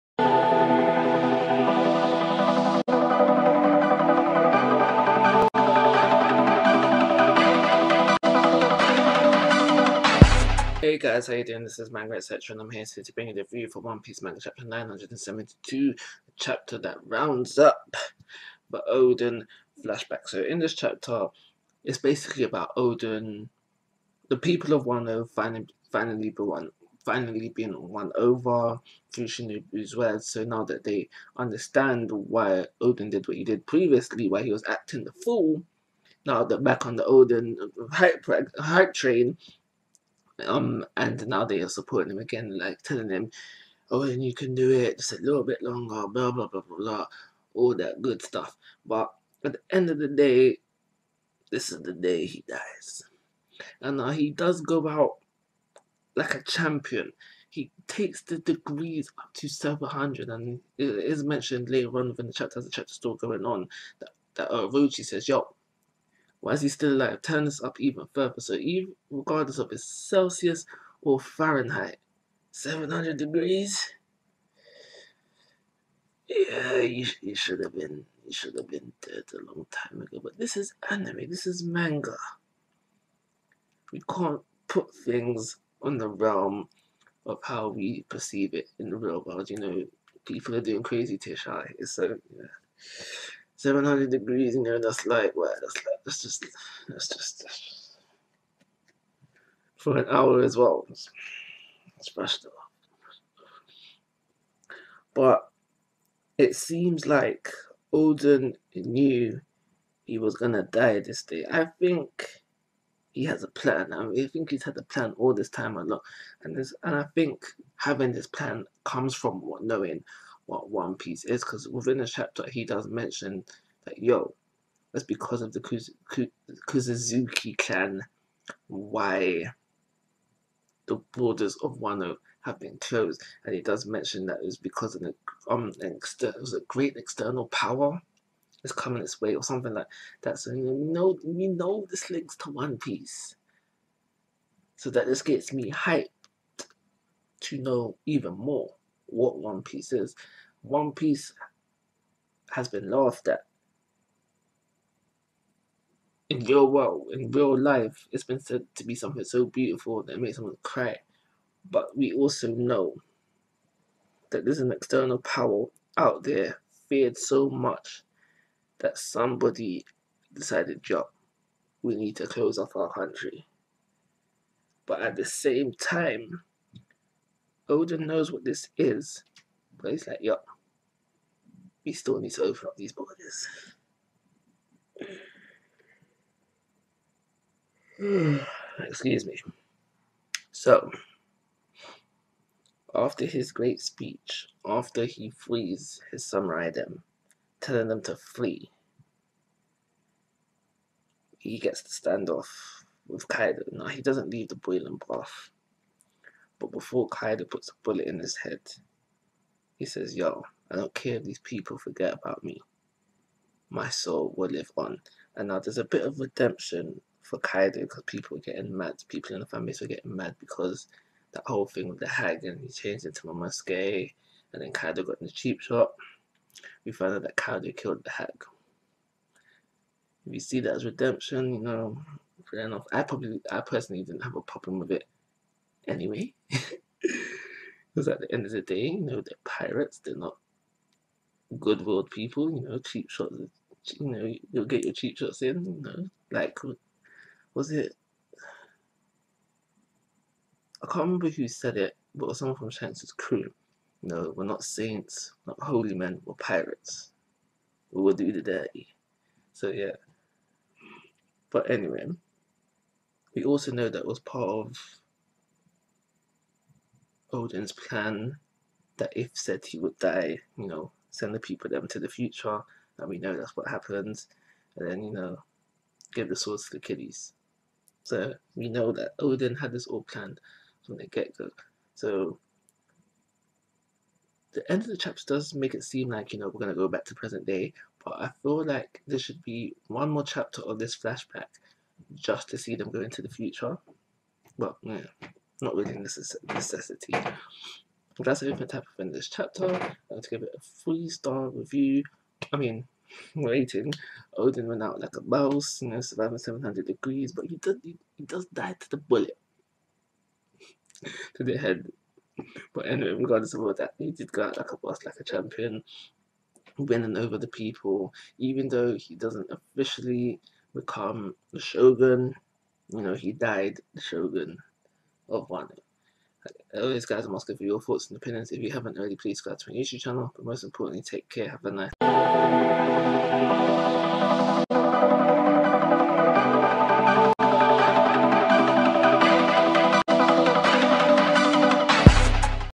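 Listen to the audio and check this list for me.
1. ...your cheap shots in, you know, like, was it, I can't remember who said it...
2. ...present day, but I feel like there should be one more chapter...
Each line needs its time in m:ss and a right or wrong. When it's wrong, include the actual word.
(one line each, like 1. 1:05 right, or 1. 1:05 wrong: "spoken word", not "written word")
1. 4:04 right
2. 4:47 right.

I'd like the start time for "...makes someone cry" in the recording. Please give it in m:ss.
2:40.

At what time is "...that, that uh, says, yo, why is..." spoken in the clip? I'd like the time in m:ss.
1:03.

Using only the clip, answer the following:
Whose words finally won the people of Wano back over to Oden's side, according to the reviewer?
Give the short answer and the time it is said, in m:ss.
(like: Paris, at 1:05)
Shinobu, at 0:29.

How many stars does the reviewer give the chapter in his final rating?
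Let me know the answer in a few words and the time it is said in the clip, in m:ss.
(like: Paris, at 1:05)
3, at 5:00.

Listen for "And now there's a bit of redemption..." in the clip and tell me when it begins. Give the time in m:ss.
3:35.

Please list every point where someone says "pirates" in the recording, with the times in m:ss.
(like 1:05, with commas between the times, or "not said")
3:59, 4:16.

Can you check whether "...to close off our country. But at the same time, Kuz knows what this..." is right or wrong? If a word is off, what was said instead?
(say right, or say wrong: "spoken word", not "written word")
wrong: "Oden", not "Kuz".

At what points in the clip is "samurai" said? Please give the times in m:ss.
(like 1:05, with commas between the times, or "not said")
3:16.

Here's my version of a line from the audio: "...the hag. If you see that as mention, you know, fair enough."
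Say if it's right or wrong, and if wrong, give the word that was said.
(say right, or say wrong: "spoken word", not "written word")
wrong: "redemption", not "mention".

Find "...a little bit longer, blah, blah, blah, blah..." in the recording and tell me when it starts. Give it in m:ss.
0:45.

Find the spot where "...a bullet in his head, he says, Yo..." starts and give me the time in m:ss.
3:27.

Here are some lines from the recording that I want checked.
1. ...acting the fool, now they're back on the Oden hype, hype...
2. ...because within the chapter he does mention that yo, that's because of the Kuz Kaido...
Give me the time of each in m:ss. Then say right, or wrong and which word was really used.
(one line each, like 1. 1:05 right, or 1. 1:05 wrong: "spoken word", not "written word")
1. 0:34 right
2. 2:01 wrong: "Kuzuzuki", not "Kaido".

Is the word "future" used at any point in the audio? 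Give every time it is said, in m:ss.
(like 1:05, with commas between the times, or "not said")
4:32, 4:53.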